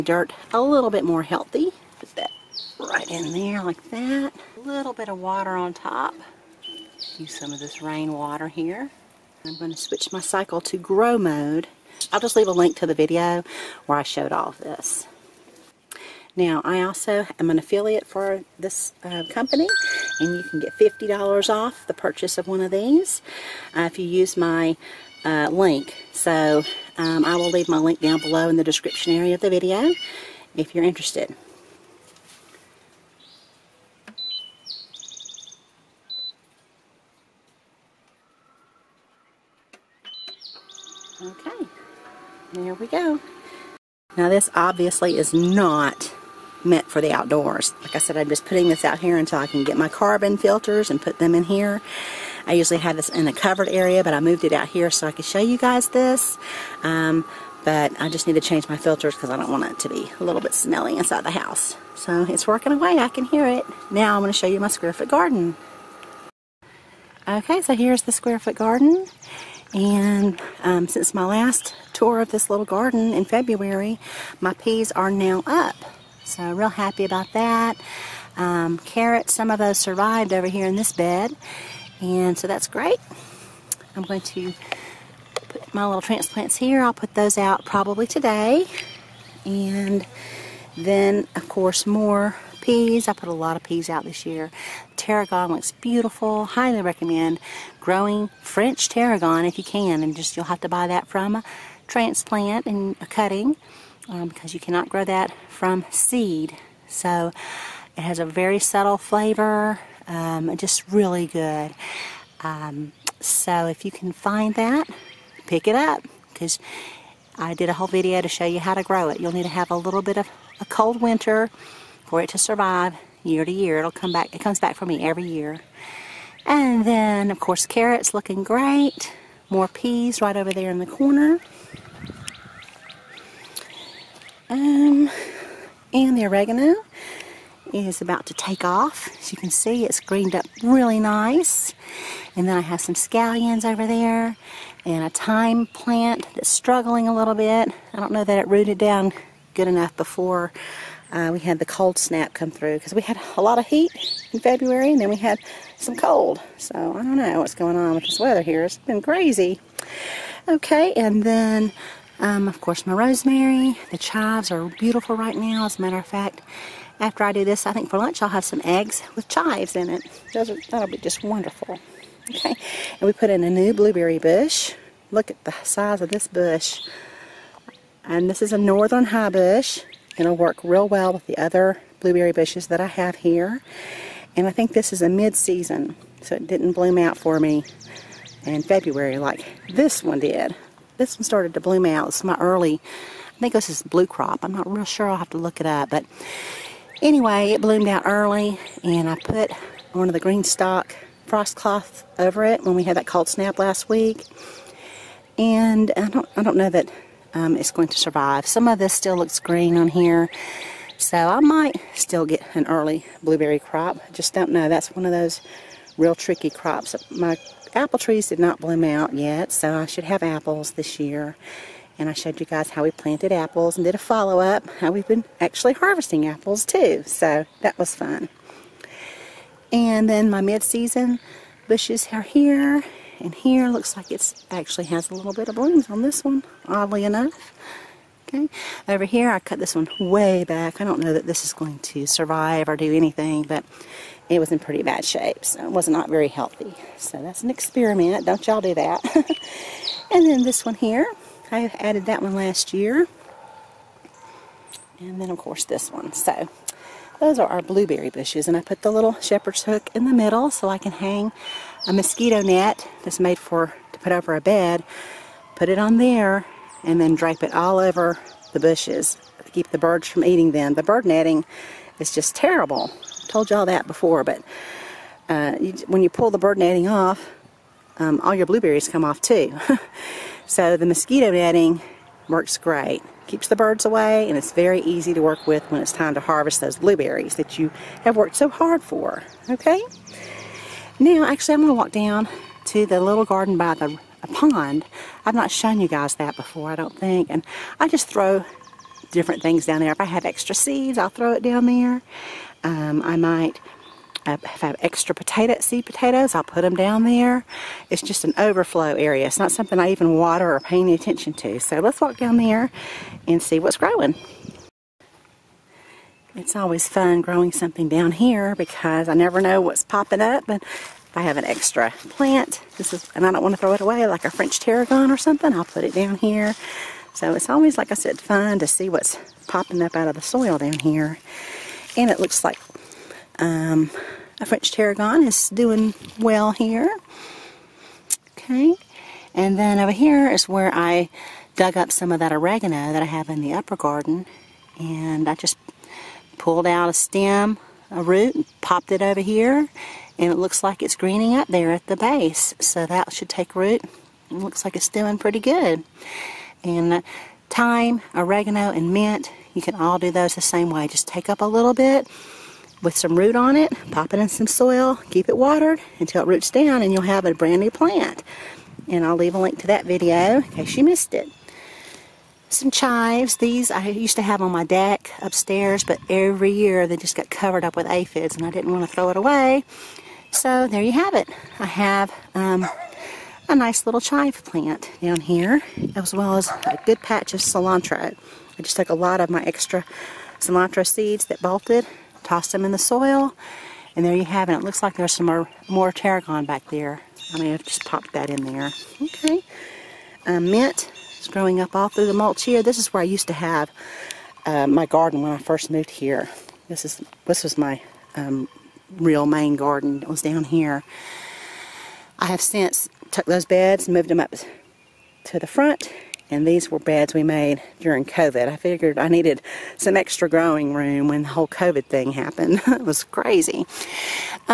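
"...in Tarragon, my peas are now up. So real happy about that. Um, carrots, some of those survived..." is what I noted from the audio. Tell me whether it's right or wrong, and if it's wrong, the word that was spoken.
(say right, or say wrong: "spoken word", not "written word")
wrong: "February", not "Tarragon".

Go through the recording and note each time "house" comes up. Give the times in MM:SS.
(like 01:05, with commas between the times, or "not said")
01:01.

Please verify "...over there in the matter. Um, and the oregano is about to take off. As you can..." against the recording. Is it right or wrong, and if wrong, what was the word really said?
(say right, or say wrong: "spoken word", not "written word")
wrong: "corner", not "matter".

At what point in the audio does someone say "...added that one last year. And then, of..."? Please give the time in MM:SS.
04:11.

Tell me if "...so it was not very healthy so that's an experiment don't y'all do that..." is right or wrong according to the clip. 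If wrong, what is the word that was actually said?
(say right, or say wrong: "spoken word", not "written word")
right.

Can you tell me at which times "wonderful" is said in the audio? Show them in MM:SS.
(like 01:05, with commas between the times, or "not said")
02:51.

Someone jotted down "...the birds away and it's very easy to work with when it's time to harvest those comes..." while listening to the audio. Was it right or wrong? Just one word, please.
wrong.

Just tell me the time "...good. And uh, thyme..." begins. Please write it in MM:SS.
05:55.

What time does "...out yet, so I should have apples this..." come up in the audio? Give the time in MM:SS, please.
03:38.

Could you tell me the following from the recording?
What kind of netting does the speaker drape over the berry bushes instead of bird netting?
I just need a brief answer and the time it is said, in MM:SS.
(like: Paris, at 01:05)
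mosquito net, at 04:21.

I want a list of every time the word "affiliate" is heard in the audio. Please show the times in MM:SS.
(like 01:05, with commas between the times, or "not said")
00:17.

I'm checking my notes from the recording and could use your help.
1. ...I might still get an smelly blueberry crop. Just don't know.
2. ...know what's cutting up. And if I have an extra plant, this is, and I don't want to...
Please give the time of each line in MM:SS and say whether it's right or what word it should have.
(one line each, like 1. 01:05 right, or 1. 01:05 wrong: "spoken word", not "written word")
1. 03:31 wrong: "early", not "smelly"
2. 05:19 wrong: "popping", not "cutting".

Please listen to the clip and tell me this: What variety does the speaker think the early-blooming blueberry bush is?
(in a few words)
Bluecrop.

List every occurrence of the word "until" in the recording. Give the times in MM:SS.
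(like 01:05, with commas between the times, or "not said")
00:49, 06:05.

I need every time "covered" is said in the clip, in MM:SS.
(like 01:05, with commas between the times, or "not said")
00:53, 06:17.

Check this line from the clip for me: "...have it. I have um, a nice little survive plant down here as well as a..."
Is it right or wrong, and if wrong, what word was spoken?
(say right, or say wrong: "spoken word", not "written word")
wrong: "chive", not "survive".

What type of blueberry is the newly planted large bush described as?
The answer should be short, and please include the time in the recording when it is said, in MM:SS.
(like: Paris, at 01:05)
northern high bush, at 02:58.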